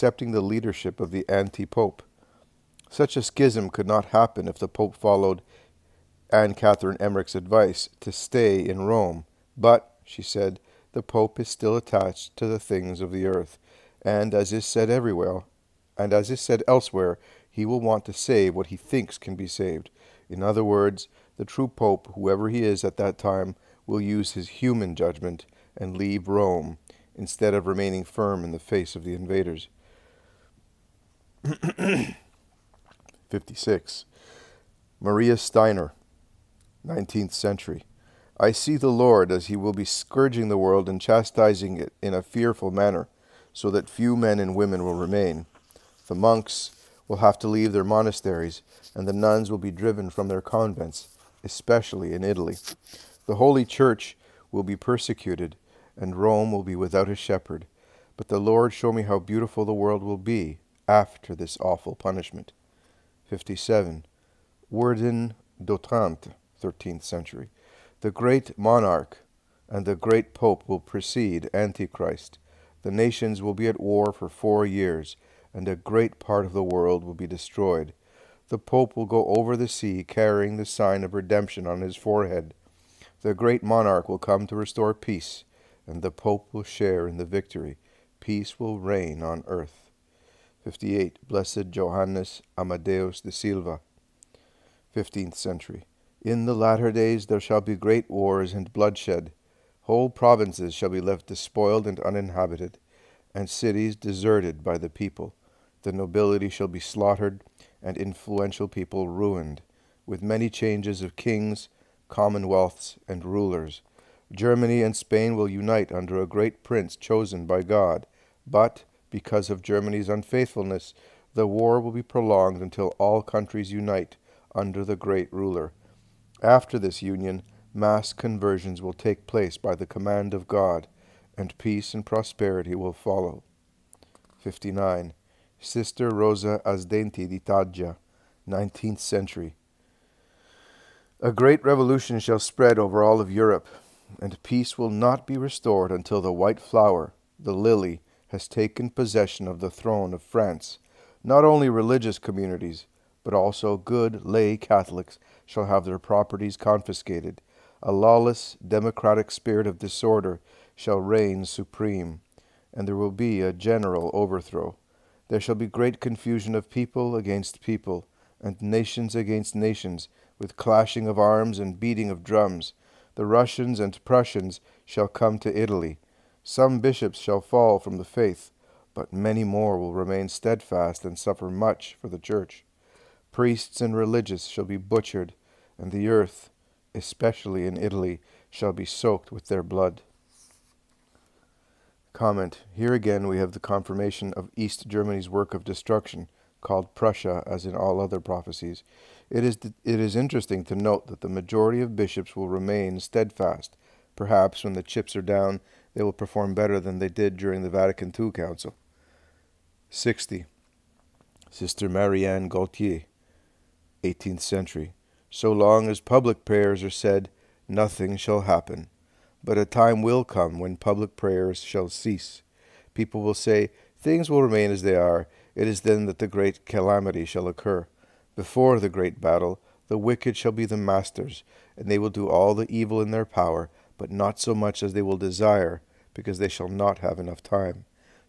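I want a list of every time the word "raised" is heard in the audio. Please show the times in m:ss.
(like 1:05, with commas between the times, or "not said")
not said.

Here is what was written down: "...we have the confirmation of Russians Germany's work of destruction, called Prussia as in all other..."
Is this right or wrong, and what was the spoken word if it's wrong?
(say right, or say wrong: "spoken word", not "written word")
wrong: "East", not "Russians".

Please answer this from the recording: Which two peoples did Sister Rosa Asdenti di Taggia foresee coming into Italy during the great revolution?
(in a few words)
Russians and Prussians.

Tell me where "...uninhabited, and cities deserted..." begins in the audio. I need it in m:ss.
1:41.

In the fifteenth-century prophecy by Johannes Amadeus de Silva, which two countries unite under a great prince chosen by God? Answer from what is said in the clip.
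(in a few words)
Germany and Spain.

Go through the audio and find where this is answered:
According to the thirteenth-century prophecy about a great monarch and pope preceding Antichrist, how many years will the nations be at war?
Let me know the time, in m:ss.
1:14.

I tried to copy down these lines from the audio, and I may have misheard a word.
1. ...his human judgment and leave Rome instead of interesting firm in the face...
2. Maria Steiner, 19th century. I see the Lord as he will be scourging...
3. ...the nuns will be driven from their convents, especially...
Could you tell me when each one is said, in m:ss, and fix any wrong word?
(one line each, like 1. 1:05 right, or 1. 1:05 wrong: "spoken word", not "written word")
1. 0:24 wrong: "remaining", not "interesting"
2. 0:34 right
3. 0:49 right.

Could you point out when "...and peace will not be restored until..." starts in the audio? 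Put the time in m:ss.
2:24.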